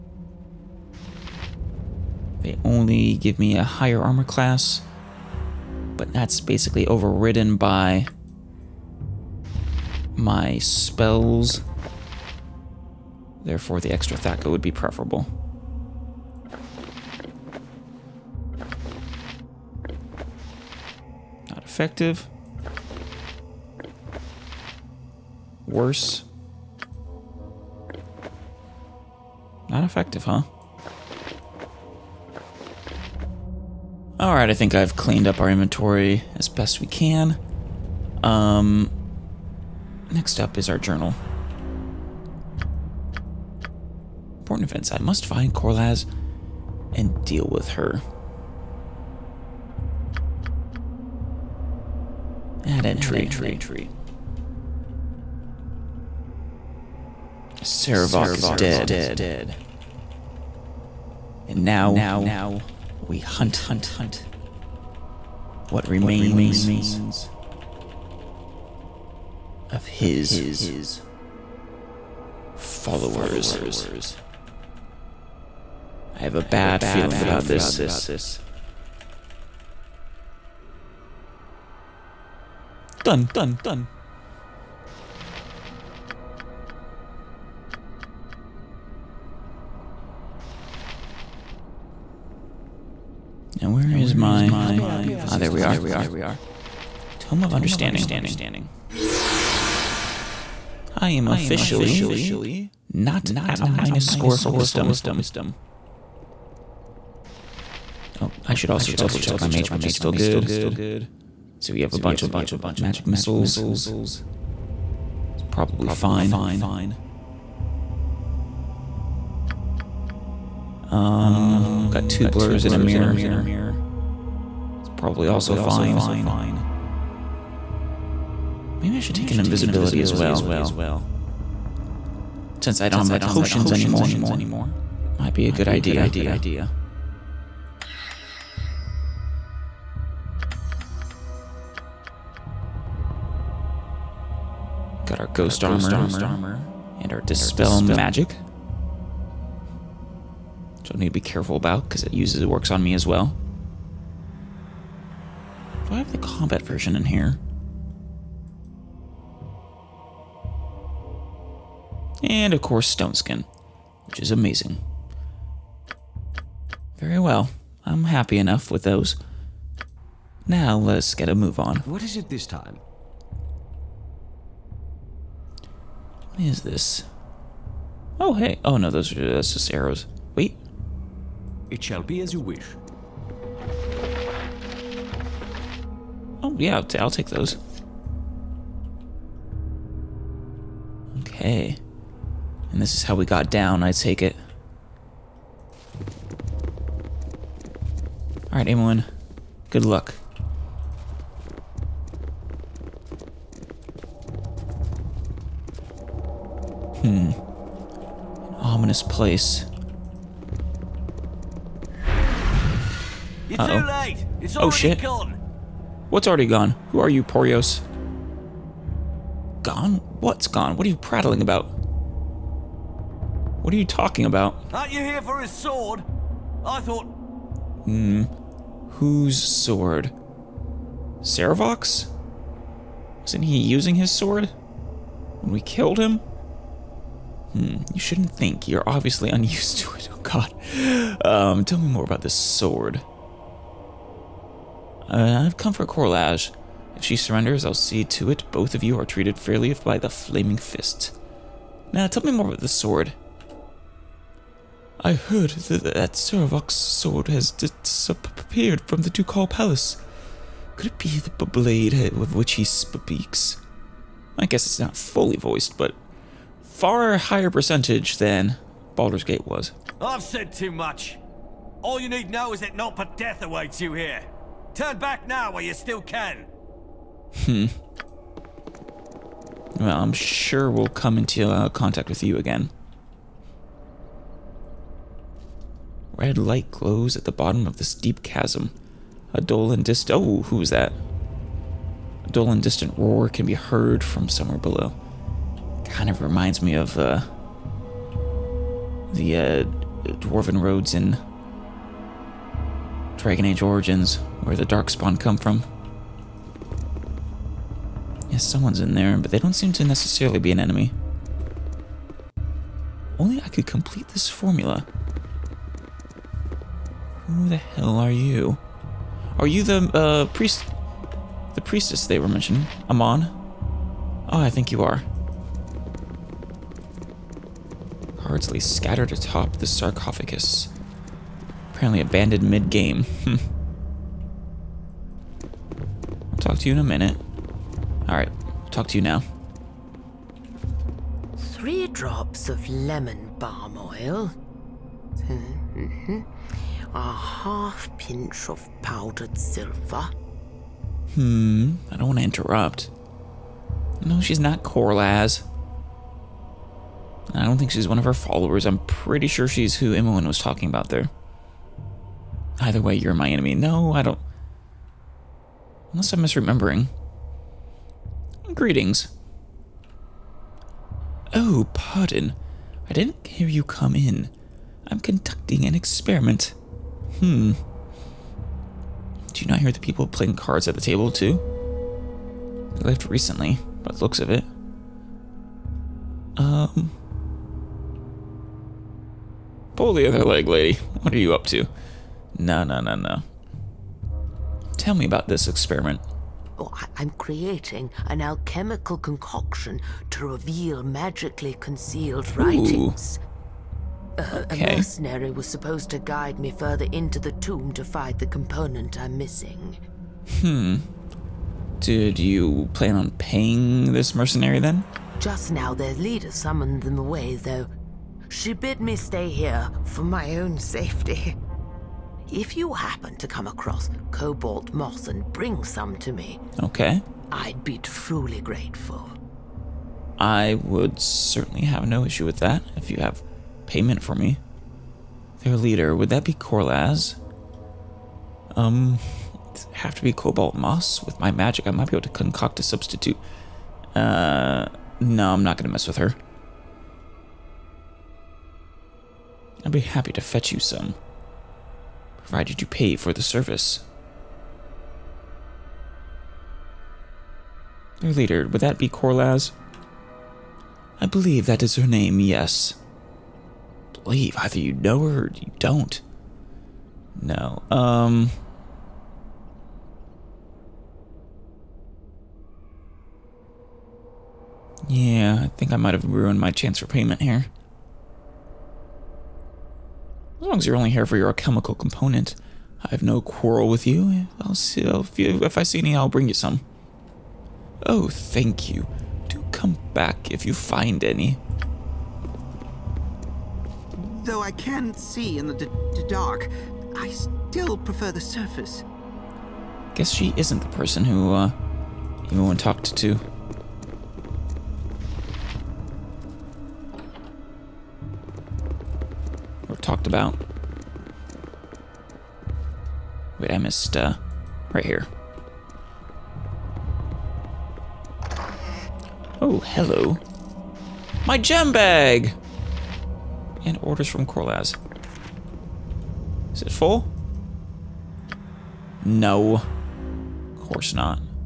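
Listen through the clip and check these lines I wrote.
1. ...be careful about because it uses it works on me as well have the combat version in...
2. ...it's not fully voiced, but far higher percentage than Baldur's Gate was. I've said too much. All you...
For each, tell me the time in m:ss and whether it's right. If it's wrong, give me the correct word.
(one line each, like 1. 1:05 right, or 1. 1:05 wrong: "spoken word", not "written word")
1. 2:31 right
2. 4:24 right.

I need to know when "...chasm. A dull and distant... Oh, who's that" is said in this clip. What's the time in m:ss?
4:48.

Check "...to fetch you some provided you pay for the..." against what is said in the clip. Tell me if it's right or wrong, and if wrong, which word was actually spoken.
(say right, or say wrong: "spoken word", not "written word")
right.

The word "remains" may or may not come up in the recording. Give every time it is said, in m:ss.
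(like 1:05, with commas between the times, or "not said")
1:05.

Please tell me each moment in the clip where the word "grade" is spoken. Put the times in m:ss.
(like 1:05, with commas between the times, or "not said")
not said.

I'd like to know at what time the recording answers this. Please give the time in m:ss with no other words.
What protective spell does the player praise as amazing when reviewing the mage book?
2:42.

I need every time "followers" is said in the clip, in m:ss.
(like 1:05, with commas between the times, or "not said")
1:12, 5:58.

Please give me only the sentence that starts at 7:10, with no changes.
I would certainly have no issue with that if you have payment for me.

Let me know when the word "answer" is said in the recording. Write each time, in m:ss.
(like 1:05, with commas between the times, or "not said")
not said.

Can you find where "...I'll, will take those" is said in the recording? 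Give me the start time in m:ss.
3:06.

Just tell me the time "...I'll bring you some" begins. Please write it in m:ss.
8:05.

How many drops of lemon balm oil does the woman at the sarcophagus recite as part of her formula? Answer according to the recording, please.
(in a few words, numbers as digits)
3.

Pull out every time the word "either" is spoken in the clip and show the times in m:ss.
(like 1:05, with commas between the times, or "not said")
6:02, 7:44.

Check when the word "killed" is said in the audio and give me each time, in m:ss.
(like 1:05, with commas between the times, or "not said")
3:55.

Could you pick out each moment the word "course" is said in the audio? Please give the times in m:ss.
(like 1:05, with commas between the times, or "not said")
2:42, 8:50.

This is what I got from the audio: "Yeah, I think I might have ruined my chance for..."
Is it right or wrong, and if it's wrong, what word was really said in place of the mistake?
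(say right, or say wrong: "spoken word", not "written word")
right.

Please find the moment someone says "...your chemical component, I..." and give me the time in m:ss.
8:01.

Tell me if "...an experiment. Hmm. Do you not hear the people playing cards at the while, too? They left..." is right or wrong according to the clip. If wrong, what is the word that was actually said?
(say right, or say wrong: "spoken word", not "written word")
wrong: "table", not "while".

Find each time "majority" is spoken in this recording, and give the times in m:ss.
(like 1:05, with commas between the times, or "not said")
not said.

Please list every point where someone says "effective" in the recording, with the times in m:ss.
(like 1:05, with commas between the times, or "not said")
0:21, 0:29.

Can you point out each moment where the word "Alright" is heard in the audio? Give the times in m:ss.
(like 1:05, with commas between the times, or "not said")
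0:34, 3:18, 5:38.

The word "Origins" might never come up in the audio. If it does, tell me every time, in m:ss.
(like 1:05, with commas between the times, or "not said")
5:03.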